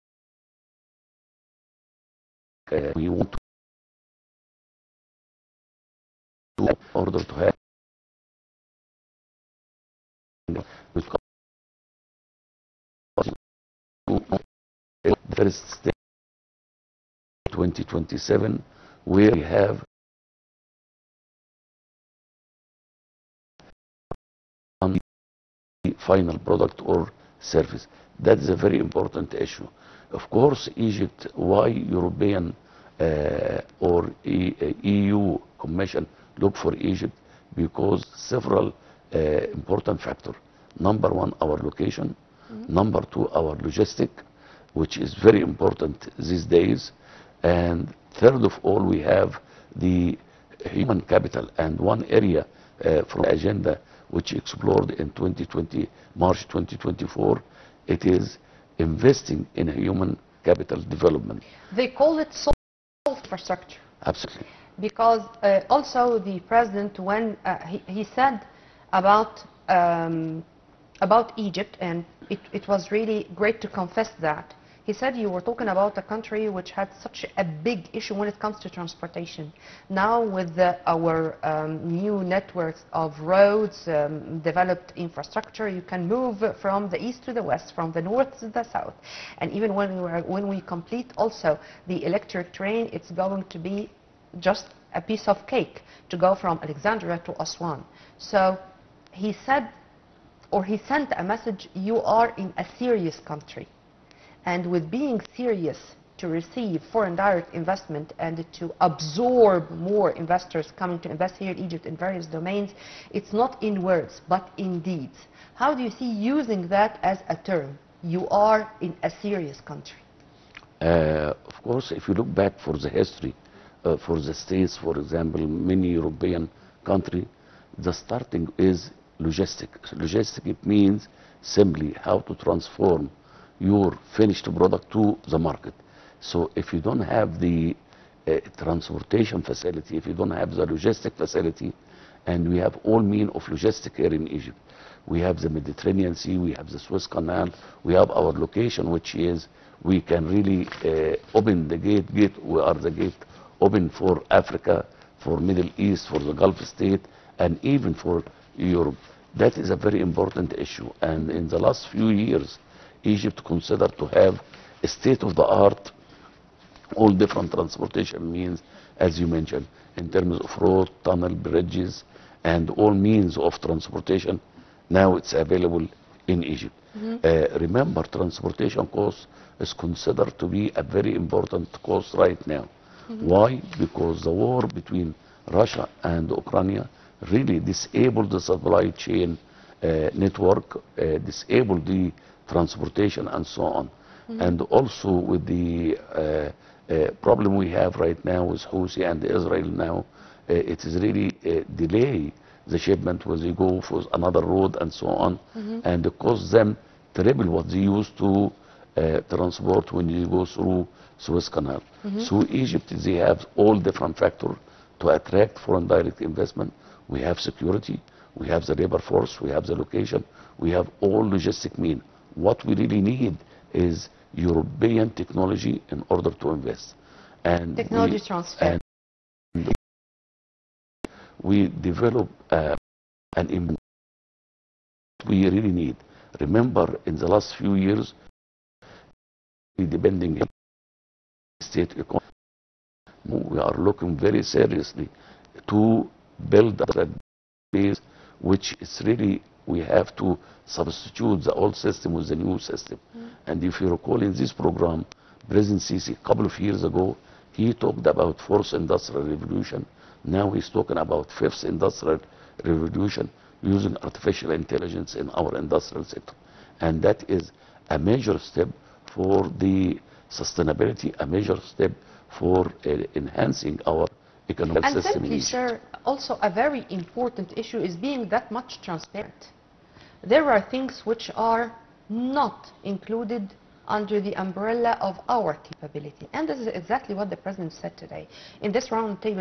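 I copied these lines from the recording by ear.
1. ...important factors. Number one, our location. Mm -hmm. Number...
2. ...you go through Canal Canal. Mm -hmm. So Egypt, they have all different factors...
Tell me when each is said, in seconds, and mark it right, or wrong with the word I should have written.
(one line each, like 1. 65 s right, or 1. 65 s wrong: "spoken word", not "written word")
1. 39 s right
2. 210 s wrong: "Suez", not "Canal".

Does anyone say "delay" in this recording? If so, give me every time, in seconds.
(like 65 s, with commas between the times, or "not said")
201 s.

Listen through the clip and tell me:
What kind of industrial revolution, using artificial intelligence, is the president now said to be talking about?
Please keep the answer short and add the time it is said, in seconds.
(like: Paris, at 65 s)
Fifth industrial revolution, at 261 s.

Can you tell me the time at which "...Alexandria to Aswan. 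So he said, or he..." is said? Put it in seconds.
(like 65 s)
96 s.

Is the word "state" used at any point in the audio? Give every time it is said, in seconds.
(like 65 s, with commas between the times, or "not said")
124 s, 156 s, 164 s, 241 s.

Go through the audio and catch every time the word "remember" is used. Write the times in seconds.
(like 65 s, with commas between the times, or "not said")
177 s, 236 s.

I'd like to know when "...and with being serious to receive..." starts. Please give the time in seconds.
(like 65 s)
104 s.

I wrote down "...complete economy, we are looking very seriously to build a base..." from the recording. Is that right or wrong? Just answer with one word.
wrong.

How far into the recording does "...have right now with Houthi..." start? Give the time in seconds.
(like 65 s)
197 s.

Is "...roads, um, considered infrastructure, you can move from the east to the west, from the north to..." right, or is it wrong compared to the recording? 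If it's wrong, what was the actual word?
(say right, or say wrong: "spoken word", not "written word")
wrong: "developed", not "considered".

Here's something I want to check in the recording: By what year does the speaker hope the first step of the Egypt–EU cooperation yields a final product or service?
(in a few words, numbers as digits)
2027.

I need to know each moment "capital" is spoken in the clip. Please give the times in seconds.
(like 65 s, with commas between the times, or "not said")
51 s, 60 s.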